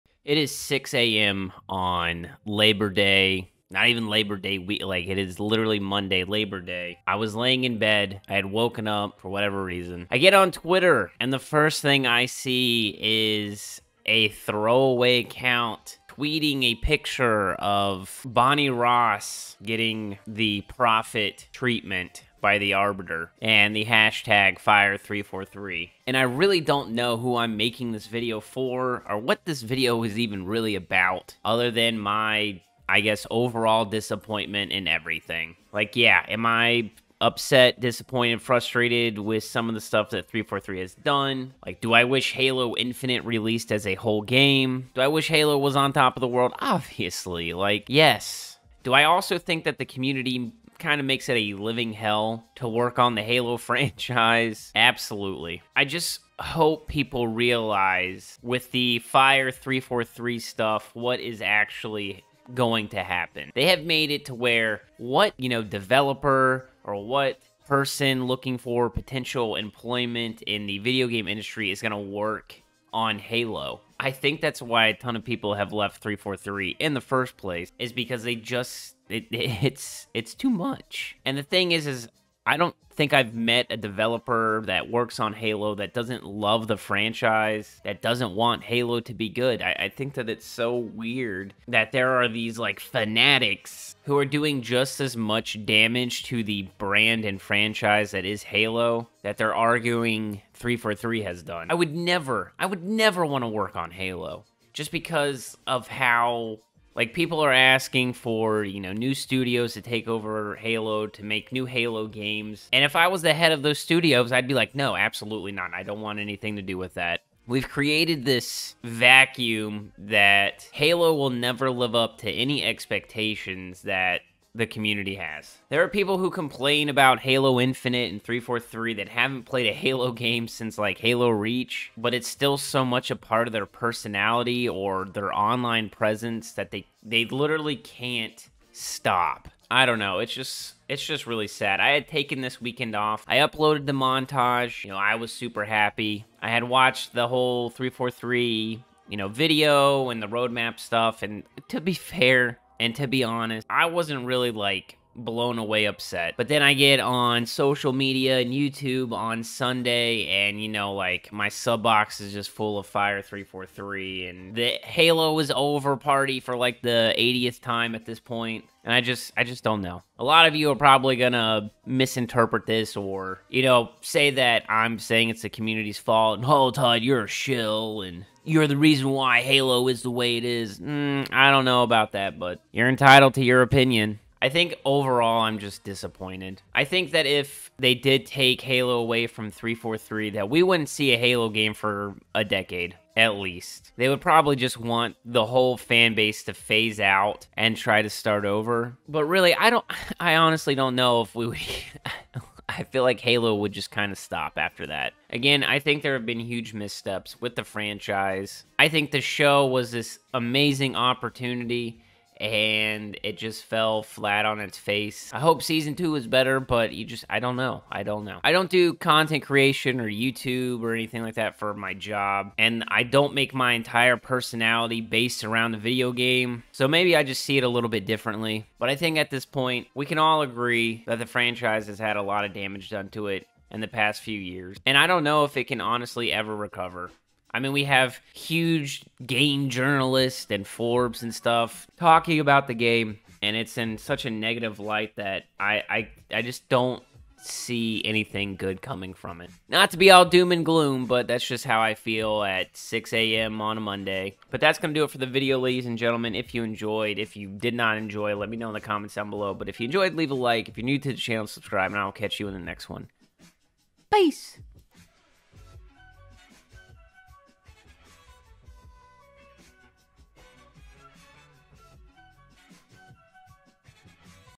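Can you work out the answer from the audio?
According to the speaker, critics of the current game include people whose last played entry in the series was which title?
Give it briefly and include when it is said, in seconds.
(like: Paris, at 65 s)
Halo Reach, at 130 s.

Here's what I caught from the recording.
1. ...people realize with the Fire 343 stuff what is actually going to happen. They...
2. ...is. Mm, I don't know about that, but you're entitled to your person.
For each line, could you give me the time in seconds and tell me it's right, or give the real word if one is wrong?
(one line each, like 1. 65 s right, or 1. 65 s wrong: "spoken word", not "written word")
1. 56 s right
2. 180 s wrong: "opinion", not "person".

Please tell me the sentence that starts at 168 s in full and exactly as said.
And I just, I just don't know.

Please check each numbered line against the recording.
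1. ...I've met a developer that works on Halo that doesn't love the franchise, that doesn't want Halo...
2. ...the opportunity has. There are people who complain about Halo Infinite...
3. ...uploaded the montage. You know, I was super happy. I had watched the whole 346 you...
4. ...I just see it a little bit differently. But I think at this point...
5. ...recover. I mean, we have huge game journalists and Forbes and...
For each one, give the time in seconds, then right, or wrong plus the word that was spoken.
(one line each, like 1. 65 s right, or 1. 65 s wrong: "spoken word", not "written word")
1. 83 s right
2. 124 s wrong: "community", not "opportunity"
3. 143 s wrong: "343", not "346"
4. 227 s right
5. 236 s right.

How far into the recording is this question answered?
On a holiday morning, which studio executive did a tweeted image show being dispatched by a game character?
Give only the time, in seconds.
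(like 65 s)
18 s.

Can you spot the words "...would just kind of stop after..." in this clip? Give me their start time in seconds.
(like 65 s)
203 s.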